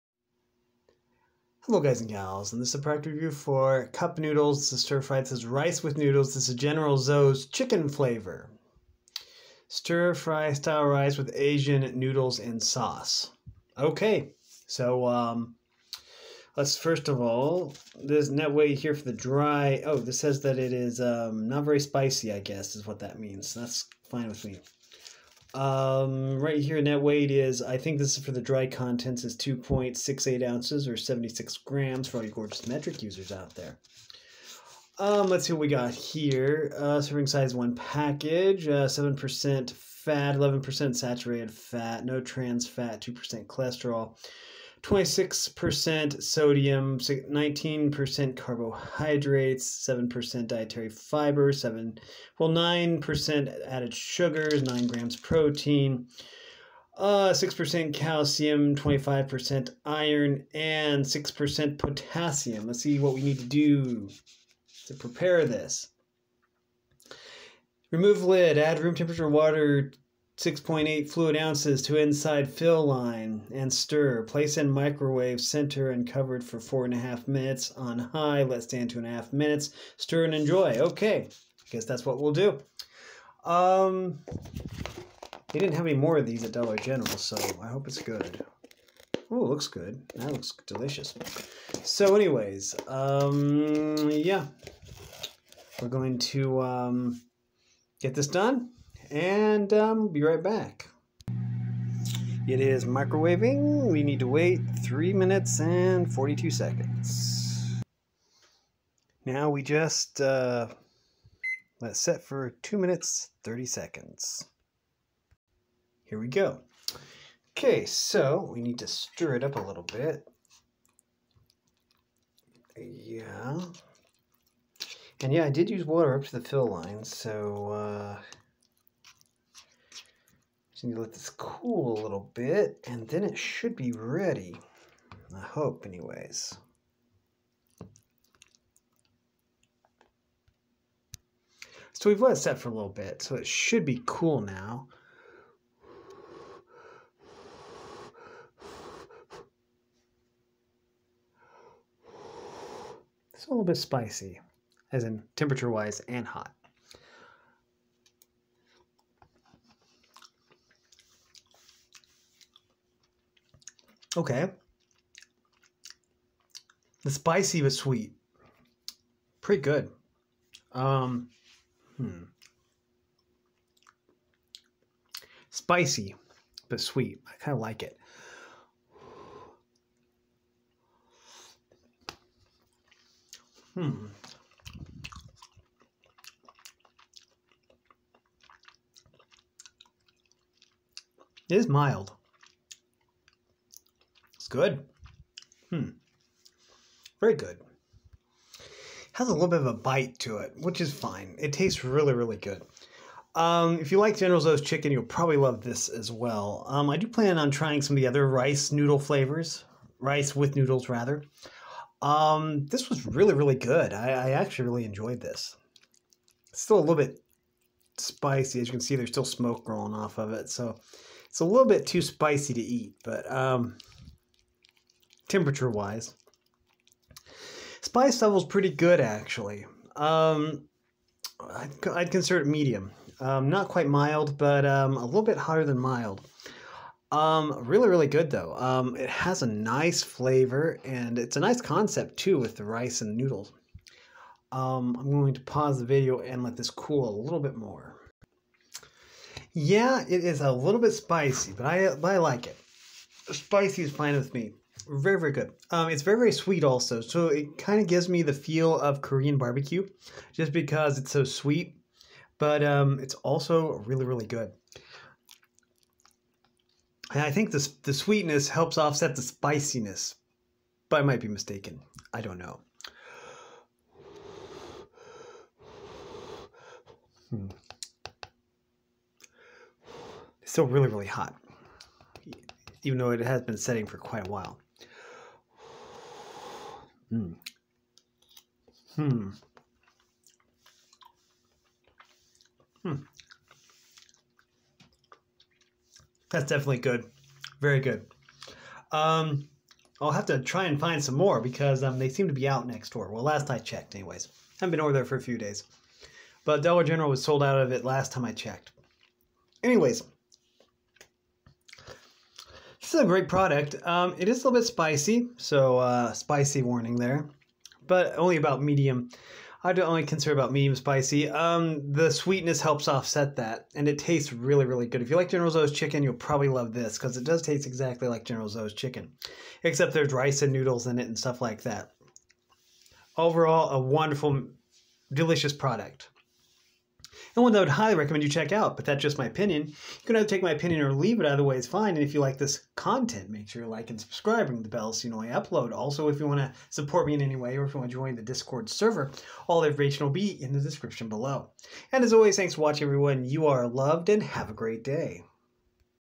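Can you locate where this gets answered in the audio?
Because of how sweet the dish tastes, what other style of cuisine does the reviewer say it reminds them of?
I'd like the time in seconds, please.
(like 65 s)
259 s.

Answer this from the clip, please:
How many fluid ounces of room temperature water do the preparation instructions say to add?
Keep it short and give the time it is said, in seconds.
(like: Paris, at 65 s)
6.8, at 70 s.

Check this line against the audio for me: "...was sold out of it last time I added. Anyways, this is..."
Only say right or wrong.
wrong.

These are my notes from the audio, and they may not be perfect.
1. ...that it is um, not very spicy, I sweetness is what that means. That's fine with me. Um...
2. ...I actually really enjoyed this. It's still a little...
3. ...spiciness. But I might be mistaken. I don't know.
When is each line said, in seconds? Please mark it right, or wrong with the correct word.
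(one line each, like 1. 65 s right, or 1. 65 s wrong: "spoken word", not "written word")
1. 20 s wrong: "guess", not "sweetness"
2. 214 s right
3. 269 s right.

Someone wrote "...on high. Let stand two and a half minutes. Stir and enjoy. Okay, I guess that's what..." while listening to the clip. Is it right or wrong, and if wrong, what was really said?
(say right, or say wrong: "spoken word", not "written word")
right.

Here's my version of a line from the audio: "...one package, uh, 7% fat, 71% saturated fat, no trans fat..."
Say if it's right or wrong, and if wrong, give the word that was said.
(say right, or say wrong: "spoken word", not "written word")
wrong: "11", not "71".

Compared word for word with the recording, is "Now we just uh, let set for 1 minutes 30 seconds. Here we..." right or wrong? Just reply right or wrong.
wrong.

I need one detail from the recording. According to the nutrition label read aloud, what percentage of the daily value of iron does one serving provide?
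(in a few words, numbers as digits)
25%.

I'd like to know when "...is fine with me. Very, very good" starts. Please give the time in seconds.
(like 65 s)
253 s.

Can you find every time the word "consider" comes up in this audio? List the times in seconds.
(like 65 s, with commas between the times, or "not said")
232 s, 320 s.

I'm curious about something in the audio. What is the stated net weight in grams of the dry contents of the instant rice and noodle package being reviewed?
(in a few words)
76 grams.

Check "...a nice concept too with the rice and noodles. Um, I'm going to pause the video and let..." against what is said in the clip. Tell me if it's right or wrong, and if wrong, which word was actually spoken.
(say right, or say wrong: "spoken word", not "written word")
right.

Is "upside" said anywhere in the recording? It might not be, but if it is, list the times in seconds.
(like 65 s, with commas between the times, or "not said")
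not said.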